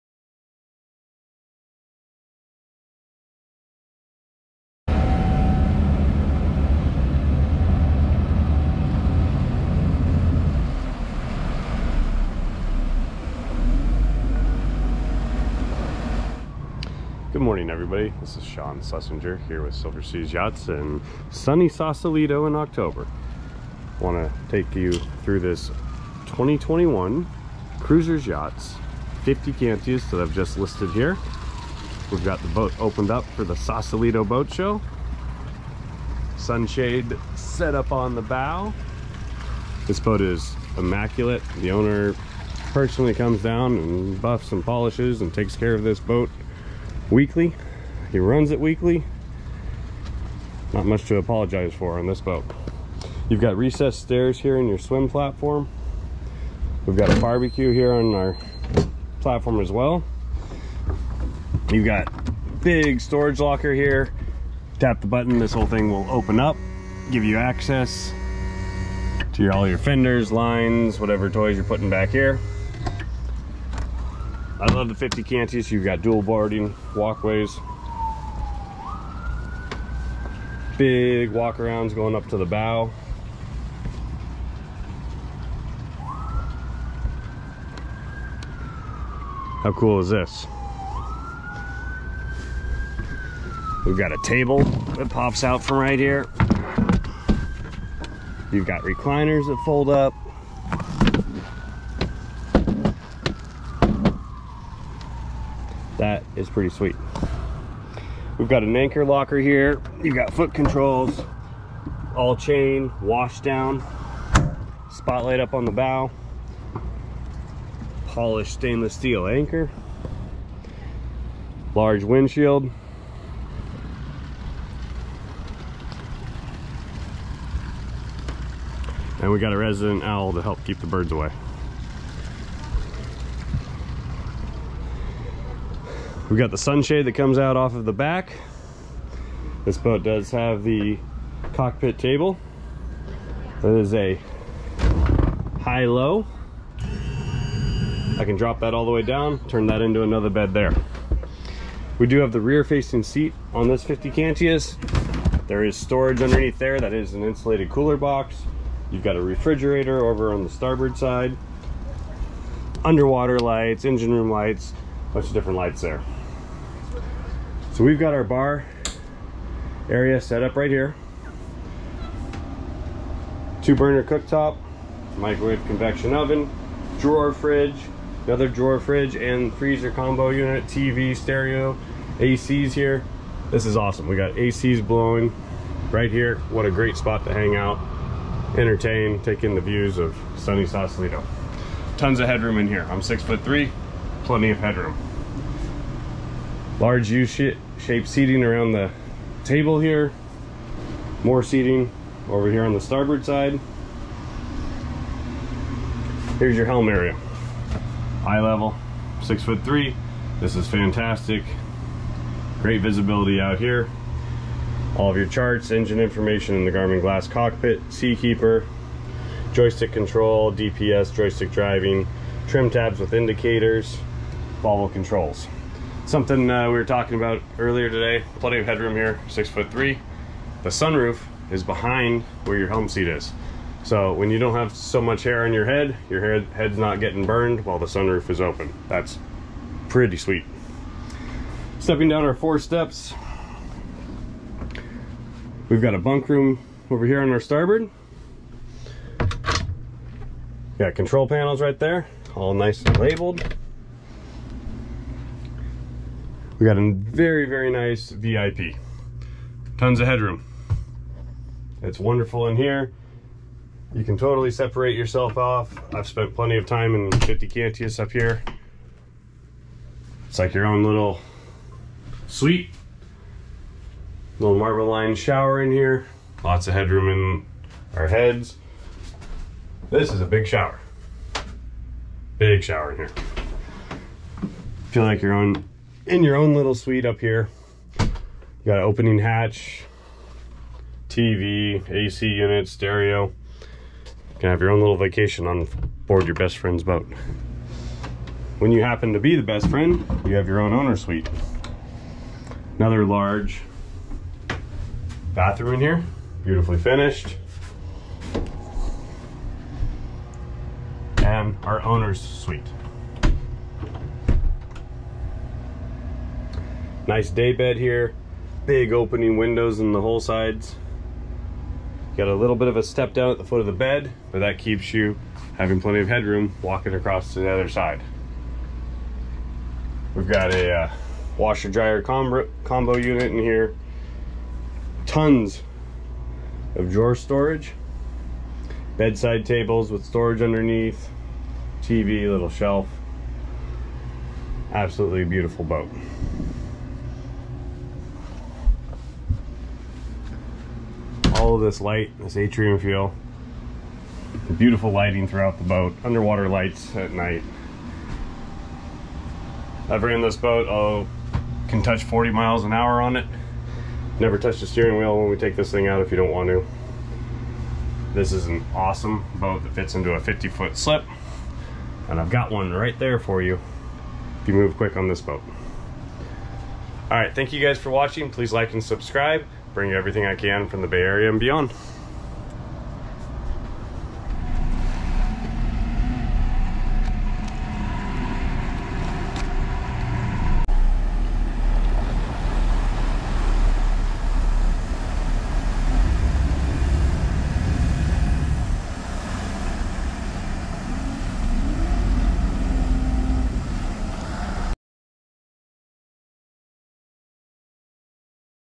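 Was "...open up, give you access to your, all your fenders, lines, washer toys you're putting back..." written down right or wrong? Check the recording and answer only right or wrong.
wrong.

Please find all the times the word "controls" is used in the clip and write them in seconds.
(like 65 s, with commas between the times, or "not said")
110 s, 219 s, 224 s, 250 s.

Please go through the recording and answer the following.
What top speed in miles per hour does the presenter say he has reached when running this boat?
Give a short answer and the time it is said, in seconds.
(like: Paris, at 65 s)
40, at 362 s.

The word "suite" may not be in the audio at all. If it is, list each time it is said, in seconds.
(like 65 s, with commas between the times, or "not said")
272 s, 286 s, 300 s, 312 s.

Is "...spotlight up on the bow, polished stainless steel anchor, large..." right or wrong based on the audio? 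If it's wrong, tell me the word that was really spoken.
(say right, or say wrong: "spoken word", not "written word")
right.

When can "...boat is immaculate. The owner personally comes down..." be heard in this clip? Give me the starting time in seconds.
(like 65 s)
39 s.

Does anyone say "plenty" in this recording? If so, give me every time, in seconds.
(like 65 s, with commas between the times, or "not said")
194 s, 228 s, 266 s, 325 s.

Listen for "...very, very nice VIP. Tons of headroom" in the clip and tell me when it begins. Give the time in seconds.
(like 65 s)
256 s.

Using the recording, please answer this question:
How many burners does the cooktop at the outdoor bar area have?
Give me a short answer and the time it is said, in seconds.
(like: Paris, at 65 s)
2, at 173 s.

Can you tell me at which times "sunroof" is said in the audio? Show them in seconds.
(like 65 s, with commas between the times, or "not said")
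230 s, 237 s.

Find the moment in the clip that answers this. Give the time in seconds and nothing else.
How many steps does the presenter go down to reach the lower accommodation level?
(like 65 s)
242 s.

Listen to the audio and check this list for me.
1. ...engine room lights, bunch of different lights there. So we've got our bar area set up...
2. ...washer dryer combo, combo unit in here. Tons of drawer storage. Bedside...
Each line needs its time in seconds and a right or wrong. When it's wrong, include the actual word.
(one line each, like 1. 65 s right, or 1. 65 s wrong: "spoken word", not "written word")
1. 163 s right
2. 331 s right.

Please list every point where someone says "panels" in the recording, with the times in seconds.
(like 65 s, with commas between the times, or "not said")
251 s.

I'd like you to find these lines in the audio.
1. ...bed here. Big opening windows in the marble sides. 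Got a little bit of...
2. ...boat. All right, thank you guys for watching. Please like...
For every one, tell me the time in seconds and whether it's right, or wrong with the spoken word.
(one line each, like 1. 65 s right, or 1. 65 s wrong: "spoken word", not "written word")
1. 317 s wrong: "whole", not "marble"
2. 375 s right.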